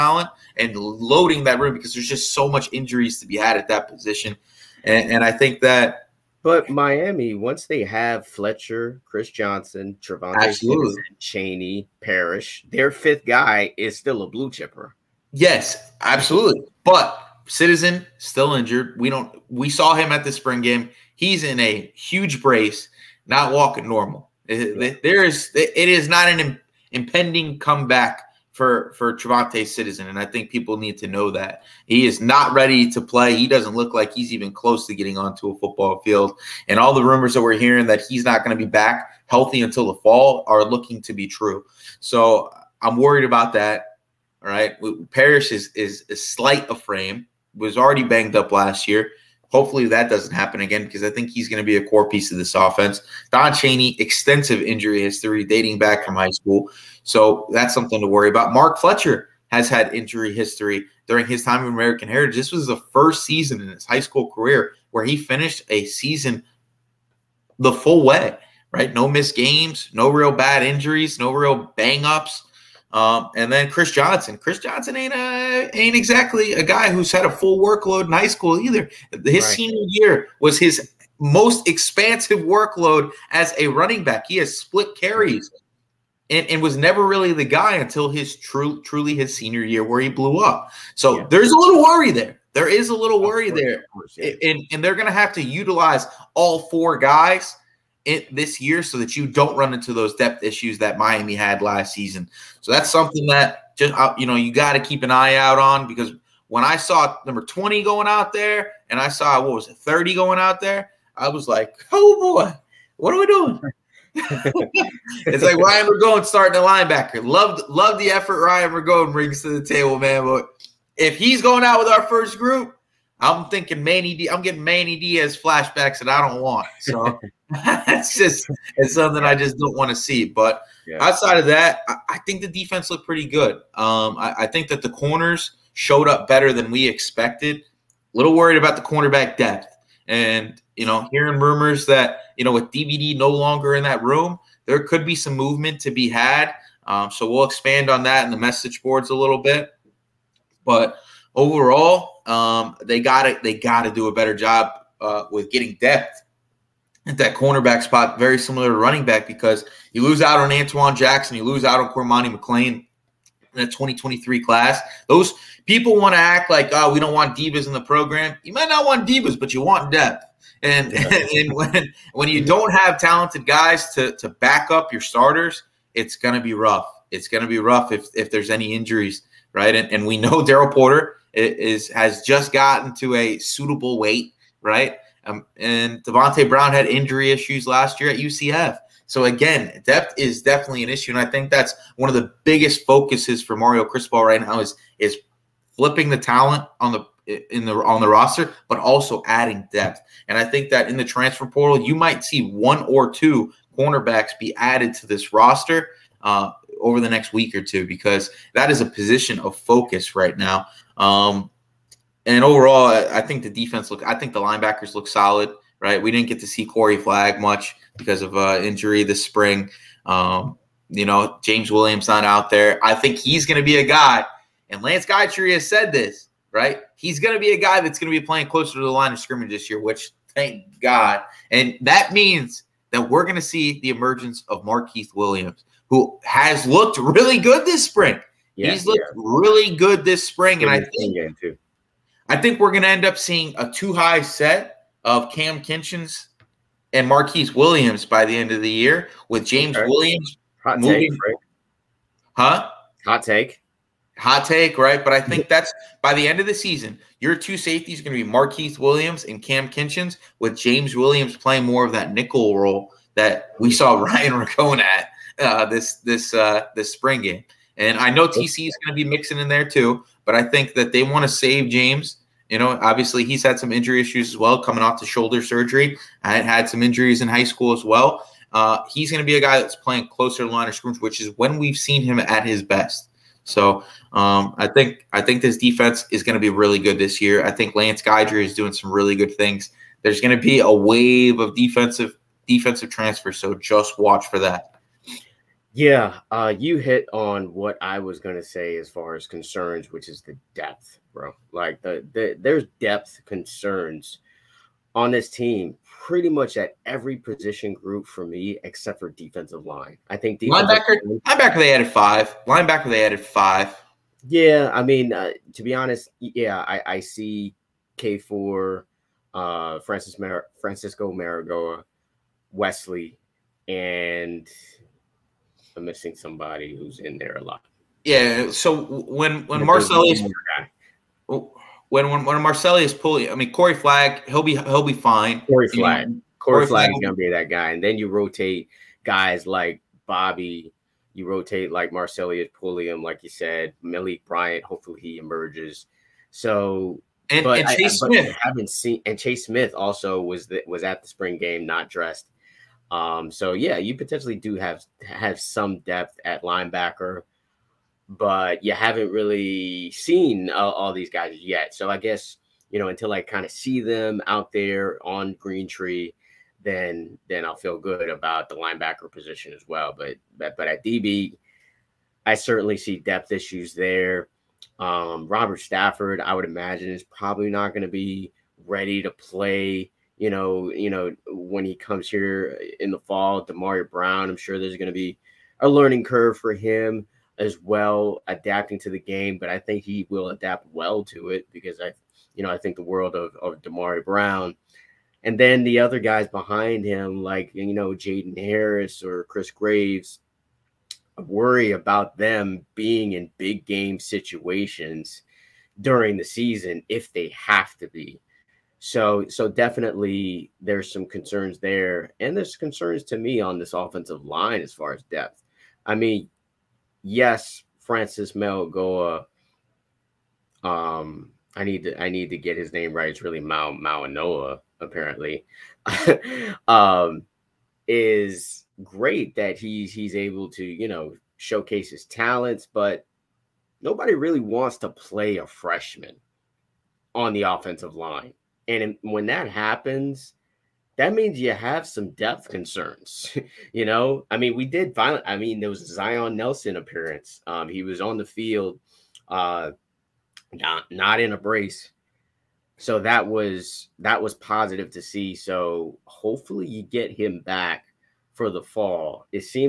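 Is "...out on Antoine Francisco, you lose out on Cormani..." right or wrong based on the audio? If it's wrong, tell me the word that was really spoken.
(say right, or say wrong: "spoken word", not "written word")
wrong: "Jackson", not "Francisco".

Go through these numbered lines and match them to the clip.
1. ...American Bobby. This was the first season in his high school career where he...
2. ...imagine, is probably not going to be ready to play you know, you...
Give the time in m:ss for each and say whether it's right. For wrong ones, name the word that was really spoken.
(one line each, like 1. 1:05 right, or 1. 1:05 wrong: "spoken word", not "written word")
1. 1:01 wrong: "Heritage", not "Bobby"
2. 6:16 right.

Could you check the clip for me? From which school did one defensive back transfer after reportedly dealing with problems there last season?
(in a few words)
UCF.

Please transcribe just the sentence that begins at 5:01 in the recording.
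Like the, the there's depth concerns on this team, pretty much at every position group for me, except for defensive line.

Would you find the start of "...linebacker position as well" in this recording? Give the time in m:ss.
6:08.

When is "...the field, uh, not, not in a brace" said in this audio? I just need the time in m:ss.
7:28.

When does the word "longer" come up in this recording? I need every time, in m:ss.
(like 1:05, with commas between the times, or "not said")
2:23.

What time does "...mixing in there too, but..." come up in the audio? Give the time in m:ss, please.
4:29.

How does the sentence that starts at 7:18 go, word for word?
And when that happens, that means you have some depth concerns.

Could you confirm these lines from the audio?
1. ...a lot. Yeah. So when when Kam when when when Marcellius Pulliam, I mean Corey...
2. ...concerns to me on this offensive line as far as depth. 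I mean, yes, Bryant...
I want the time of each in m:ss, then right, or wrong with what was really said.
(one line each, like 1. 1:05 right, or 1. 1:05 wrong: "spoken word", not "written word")
1. 5:27 wrong: "Marcellius", not "Kam"
2. 6:52 wrong: "Francis", not "Bryant".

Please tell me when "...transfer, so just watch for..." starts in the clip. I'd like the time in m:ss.
4:52.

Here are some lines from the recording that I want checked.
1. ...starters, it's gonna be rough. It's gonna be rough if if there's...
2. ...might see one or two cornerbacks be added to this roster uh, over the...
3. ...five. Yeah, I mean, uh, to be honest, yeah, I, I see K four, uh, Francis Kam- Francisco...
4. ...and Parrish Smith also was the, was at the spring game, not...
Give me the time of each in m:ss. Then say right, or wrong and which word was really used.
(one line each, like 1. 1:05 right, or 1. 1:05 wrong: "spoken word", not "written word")
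1. 2:55 right
2. 3:21 right
3. 5:13 wrong: "Mar", not "Kam"
4. 5:49 wrong: "Chase", not "Parrish".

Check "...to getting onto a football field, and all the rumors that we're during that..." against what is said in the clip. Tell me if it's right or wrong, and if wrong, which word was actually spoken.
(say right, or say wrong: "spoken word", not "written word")
wrong: "hearing", not "during".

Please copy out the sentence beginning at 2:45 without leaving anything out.
Those people want to act like, oh, we don't want divas in the program.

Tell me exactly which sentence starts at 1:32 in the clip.
There is a little worry course, there.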